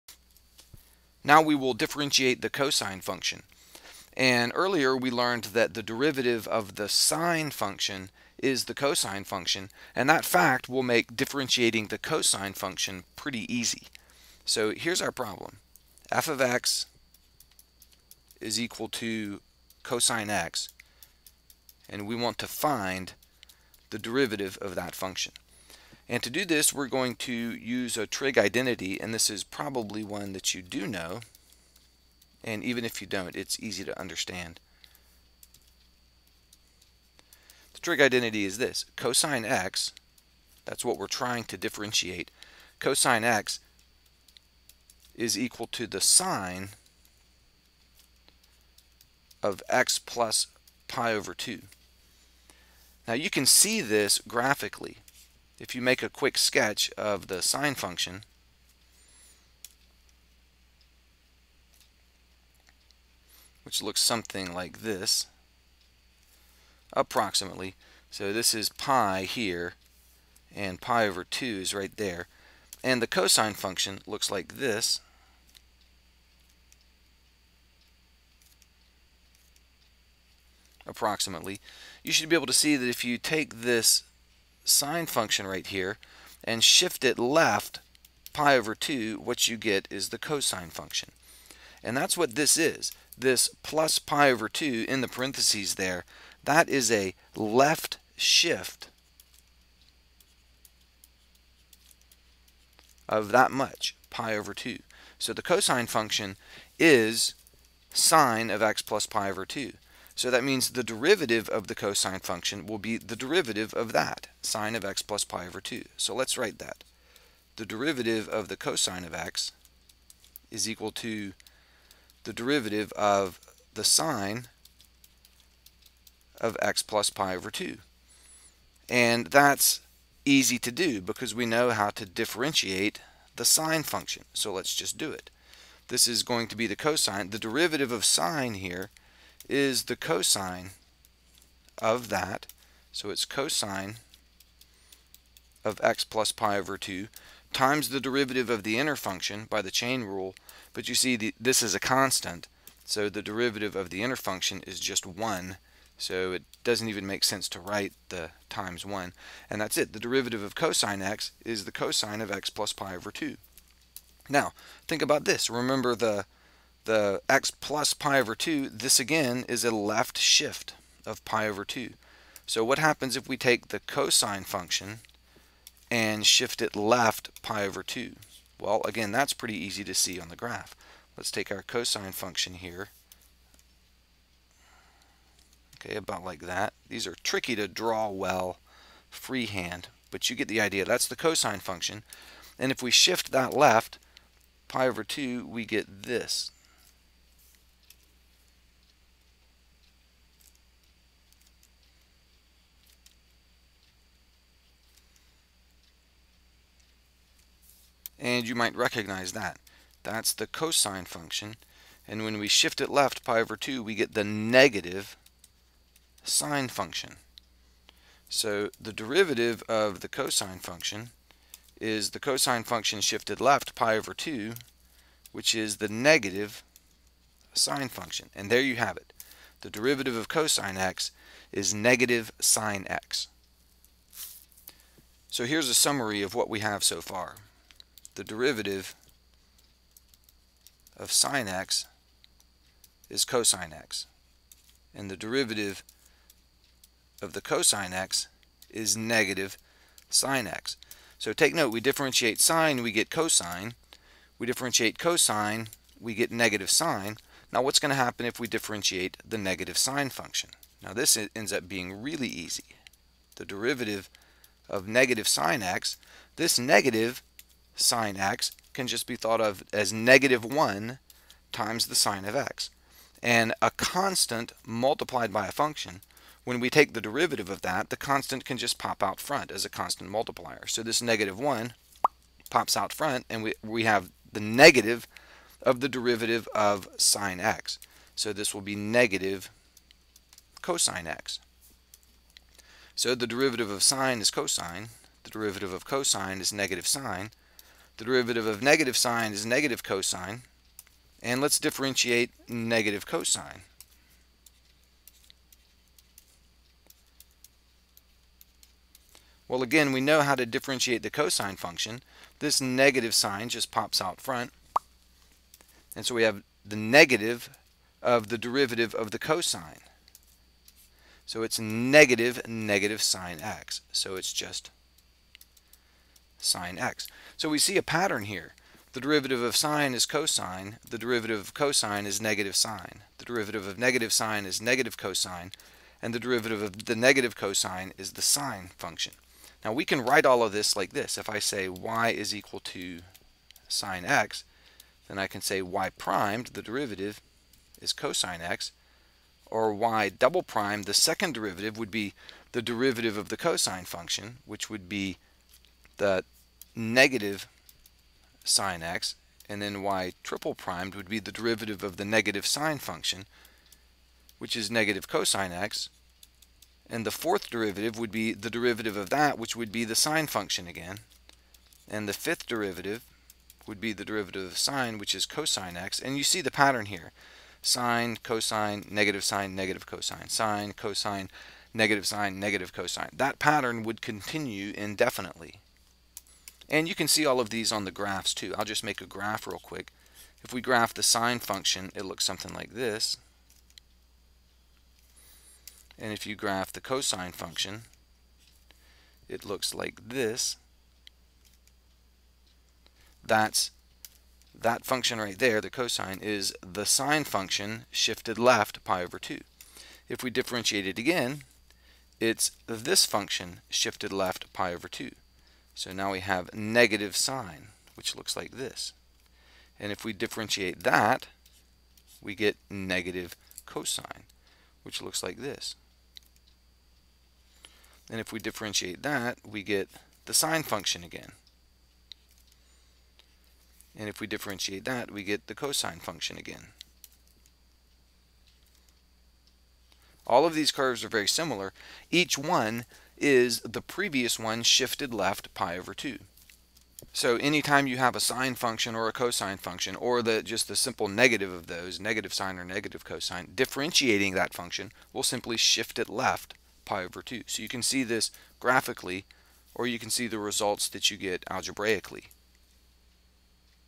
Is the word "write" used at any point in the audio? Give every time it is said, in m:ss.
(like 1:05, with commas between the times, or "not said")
1:56, 2:37, 5:40.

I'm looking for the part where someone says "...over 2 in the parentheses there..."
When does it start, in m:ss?
1:34.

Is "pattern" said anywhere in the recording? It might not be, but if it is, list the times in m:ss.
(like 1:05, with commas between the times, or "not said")
5:27, 6:16, 6:23.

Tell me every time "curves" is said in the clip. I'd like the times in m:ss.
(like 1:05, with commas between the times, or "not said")
7:20.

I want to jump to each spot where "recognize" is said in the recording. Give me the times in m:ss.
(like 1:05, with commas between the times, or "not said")
3:28.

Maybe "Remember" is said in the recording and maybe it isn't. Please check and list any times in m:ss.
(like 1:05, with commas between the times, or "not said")
2:45.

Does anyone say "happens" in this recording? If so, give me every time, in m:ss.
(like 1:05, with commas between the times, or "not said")
2:52, 4:17.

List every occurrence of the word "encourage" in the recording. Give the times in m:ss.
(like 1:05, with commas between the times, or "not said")
not said.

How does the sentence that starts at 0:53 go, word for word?
Now you can see this graphically if you make a quick sketch of the sine function, which looks something like this, approximately.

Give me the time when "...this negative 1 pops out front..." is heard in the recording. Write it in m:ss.
4:40.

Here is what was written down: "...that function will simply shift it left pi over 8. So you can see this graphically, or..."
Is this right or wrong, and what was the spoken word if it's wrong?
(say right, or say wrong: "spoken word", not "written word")
wrong: "2", not "8".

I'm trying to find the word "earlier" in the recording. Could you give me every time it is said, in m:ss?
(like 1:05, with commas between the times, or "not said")
0:04.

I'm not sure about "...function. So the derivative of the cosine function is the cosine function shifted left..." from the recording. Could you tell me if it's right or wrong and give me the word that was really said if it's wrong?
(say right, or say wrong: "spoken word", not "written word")
right.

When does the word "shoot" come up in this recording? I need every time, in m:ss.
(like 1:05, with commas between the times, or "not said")
not said.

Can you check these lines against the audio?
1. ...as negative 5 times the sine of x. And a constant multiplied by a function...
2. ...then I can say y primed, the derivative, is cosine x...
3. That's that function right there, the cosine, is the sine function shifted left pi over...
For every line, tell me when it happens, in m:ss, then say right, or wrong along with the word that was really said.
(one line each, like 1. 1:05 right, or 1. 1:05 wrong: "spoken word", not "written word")
1. 4:29 wrong: "1", not "5"
2. 5:45 right
3. 6:43 right.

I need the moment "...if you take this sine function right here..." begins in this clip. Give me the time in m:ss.
1:22.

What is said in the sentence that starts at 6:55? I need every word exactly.
So now we have negative sine, which looks like this.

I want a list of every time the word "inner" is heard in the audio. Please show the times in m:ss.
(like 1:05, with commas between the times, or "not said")
2:28, 2:34.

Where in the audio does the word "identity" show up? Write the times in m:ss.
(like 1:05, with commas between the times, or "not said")
0:28, 0:38.